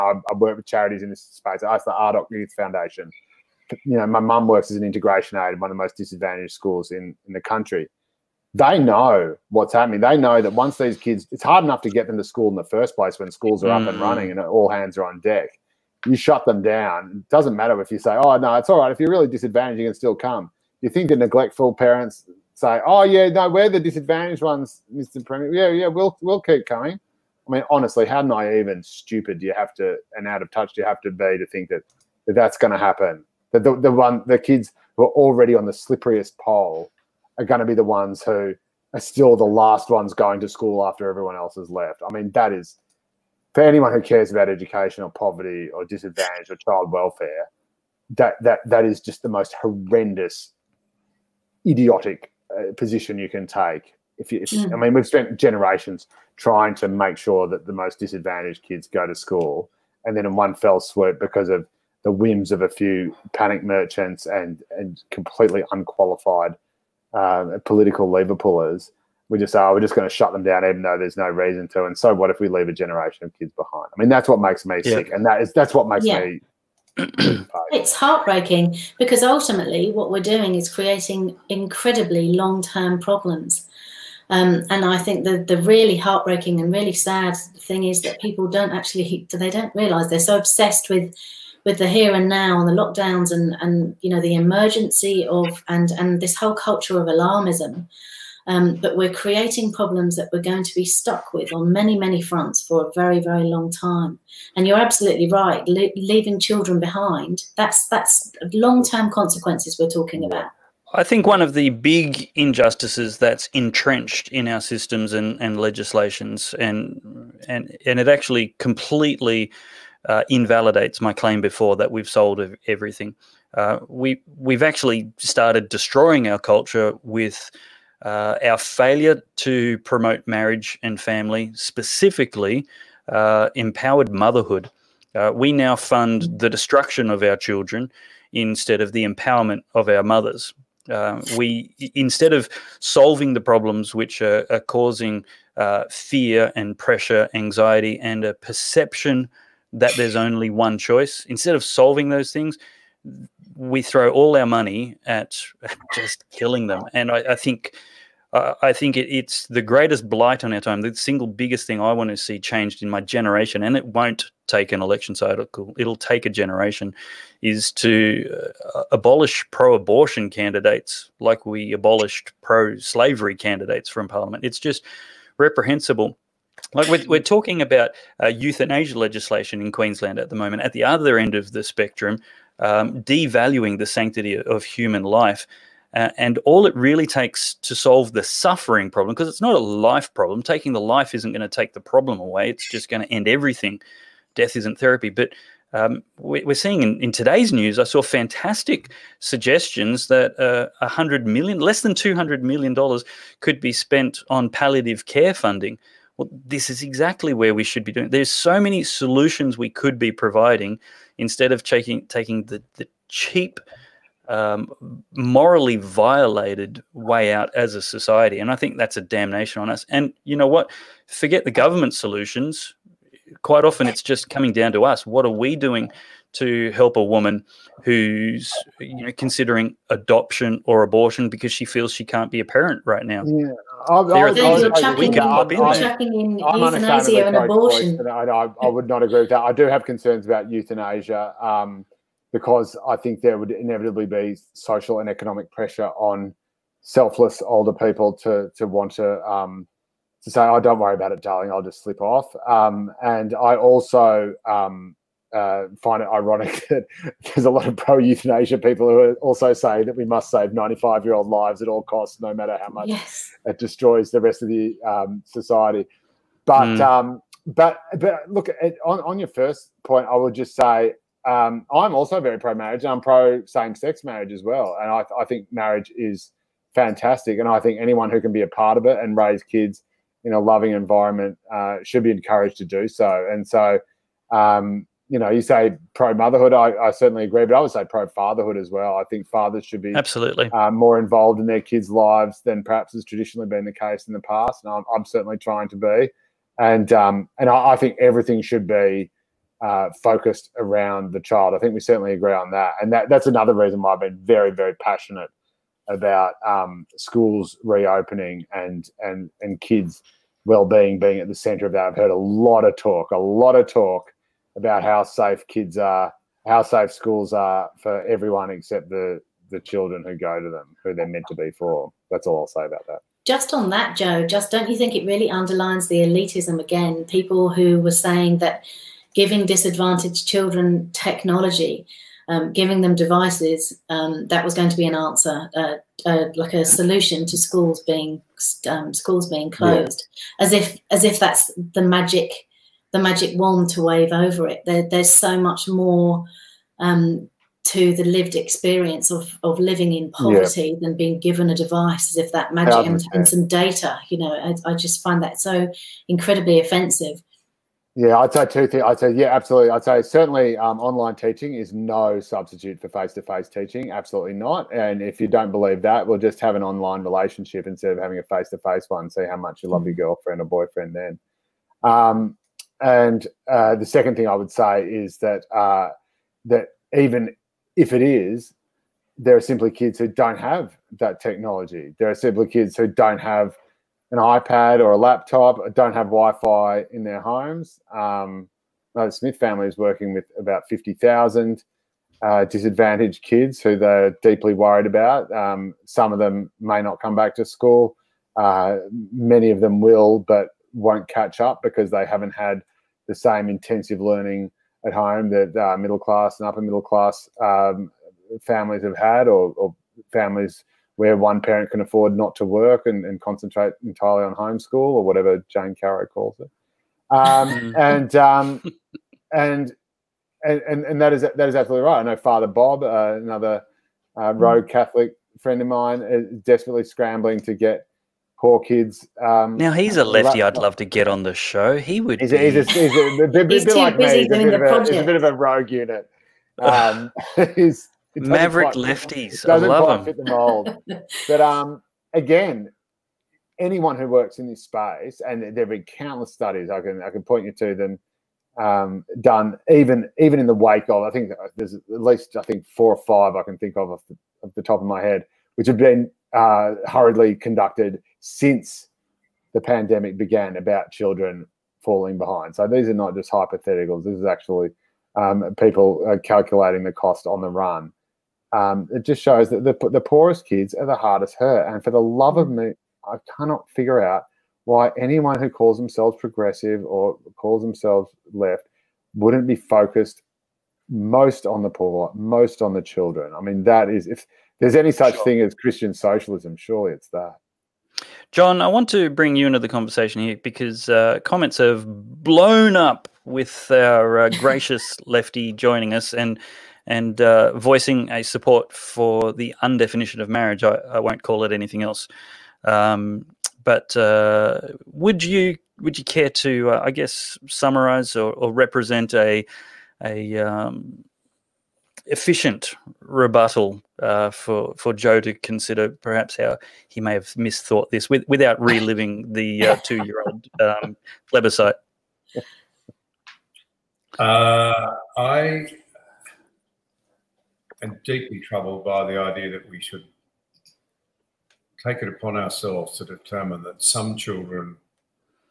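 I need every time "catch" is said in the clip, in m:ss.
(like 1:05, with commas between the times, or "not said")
6:41.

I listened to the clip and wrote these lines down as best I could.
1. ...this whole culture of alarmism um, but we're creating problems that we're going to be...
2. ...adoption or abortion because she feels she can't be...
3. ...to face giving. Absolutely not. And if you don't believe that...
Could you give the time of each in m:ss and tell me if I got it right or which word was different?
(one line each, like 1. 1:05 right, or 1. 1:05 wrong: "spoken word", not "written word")
1. 1:36 right
2. 3:49 right
3. 6:03 wrong: "teaching", not "giving".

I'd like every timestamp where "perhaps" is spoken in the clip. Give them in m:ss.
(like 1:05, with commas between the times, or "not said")
4:52, 8:35.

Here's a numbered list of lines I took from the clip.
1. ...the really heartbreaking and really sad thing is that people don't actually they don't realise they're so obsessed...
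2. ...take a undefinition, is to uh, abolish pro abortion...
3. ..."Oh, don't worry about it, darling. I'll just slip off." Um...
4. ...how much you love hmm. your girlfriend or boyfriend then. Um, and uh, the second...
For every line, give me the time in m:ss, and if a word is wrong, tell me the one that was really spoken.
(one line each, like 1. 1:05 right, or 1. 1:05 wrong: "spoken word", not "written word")
1. 1:25 right
2. 2:45 wrong: "generation", not "undefinition"
3. 4:10 right
4. 6:09 right.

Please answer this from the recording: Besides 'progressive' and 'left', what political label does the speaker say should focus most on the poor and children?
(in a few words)
Christian socialism.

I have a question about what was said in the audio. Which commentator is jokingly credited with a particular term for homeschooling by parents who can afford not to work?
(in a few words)
Jane Caro.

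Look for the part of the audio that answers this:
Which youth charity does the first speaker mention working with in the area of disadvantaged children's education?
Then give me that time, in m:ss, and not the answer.
0:01.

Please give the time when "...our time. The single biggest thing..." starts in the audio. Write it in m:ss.
2:40.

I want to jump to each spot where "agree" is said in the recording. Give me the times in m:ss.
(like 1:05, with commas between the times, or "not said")
3:59, 4:47, 5:02.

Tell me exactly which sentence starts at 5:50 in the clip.
than being given a device as if that magic and, and, some data.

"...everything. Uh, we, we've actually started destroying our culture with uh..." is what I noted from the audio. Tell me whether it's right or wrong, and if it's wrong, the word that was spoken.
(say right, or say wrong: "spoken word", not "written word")
right.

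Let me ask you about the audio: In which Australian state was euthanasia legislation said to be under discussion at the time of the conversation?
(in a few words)
Queensland.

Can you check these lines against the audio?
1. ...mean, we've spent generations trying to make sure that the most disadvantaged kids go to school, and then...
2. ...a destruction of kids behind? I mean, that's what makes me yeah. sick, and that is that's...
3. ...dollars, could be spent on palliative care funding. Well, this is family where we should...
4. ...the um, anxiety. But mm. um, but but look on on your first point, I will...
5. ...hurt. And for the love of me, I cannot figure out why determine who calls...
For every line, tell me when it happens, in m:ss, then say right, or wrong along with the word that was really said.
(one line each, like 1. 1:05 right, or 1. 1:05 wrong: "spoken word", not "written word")
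1. 0:54 right
2. 1:12 wrong: "generation", not "destruction"
3. 3:22 wrong: "exactly", not "family"
4. 4:24 wrong: "society", not "anxiety"
5. 7:51 wrong: "anyone", not "determine".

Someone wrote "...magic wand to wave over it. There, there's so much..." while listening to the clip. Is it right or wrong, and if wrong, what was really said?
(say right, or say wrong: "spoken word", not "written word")
right.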